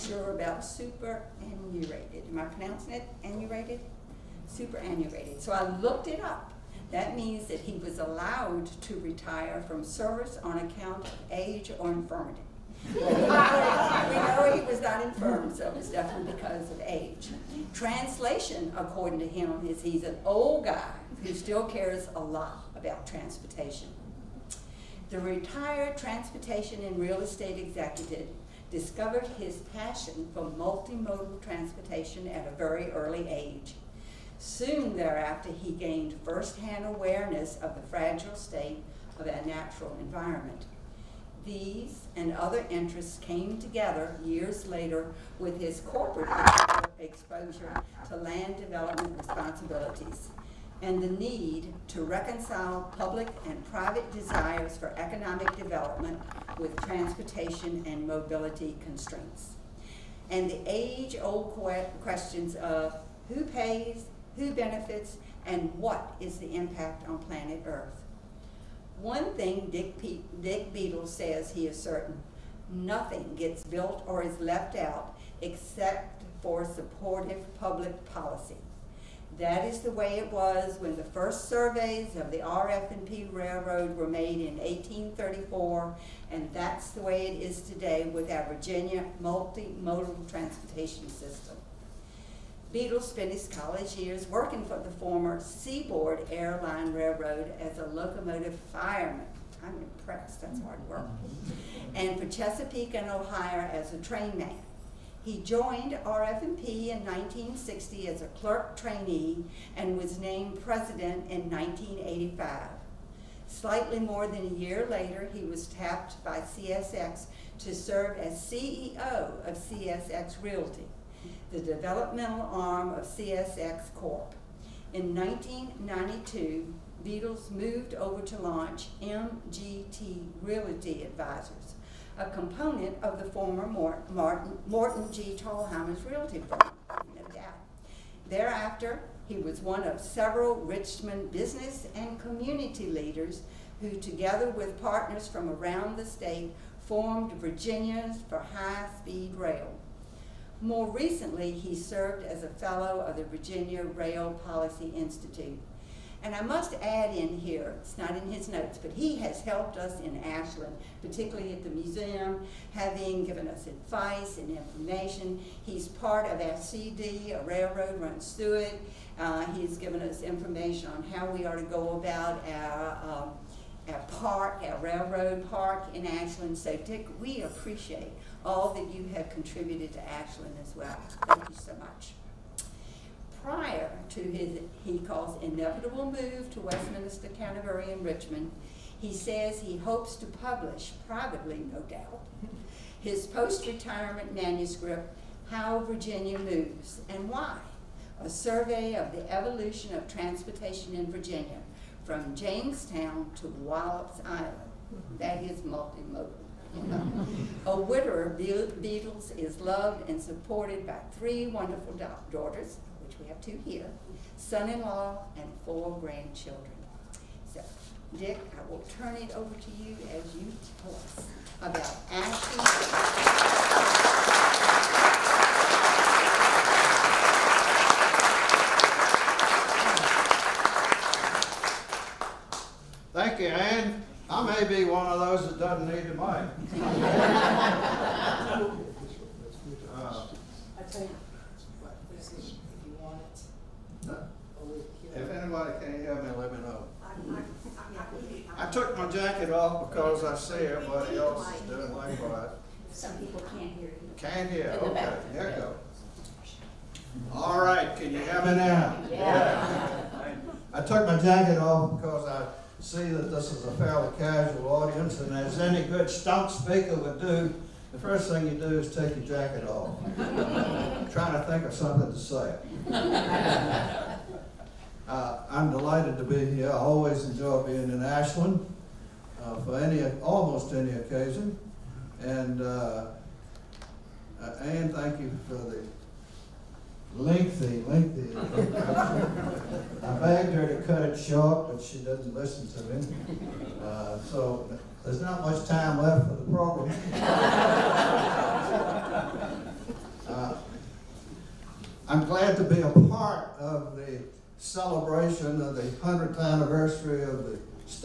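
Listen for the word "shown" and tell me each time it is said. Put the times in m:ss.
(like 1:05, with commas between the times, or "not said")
not said.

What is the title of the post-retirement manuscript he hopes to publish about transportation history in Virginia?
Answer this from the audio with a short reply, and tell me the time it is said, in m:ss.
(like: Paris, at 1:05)
How Virginia Moves and Why, at 3:15.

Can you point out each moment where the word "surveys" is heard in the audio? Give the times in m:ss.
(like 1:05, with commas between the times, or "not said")
1:21, 3:18.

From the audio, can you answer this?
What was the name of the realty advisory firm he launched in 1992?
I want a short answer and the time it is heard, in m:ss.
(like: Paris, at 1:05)
MGT Realty Advisors, at 2:08.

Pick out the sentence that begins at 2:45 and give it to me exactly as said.
He's part of our CD, a railroad runs through it.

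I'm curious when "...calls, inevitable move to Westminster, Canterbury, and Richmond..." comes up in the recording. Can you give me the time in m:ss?
3:04.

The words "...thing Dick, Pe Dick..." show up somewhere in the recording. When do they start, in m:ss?
1:09.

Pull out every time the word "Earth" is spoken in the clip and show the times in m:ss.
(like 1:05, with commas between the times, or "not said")
1:07.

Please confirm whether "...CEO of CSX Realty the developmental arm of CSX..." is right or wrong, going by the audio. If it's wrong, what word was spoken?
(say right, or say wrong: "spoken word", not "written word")
right.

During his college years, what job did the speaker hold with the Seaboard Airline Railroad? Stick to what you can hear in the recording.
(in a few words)
Locomotive fireman.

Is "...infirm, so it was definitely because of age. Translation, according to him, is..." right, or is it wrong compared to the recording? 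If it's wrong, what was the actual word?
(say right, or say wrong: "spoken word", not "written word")
right.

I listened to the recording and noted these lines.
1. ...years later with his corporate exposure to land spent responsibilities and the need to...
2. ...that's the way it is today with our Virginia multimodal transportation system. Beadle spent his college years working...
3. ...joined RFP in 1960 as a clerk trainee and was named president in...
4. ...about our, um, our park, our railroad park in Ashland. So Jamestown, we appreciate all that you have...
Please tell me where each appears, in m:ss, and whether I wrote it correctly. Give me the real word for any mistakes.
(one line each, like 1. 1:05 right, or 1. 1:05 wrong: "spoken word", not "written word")
1. 0:44 wrong: "development", not "spent"
2. 1:26 right
3. 1:45 right
4. 2:51 wrong: "Dick", not "Jamestown".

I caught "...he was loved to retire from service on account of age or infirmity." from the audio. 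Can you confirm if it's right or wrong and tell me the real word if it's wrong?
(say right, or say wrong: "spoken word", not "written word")
wrong: "allowed", not "loved".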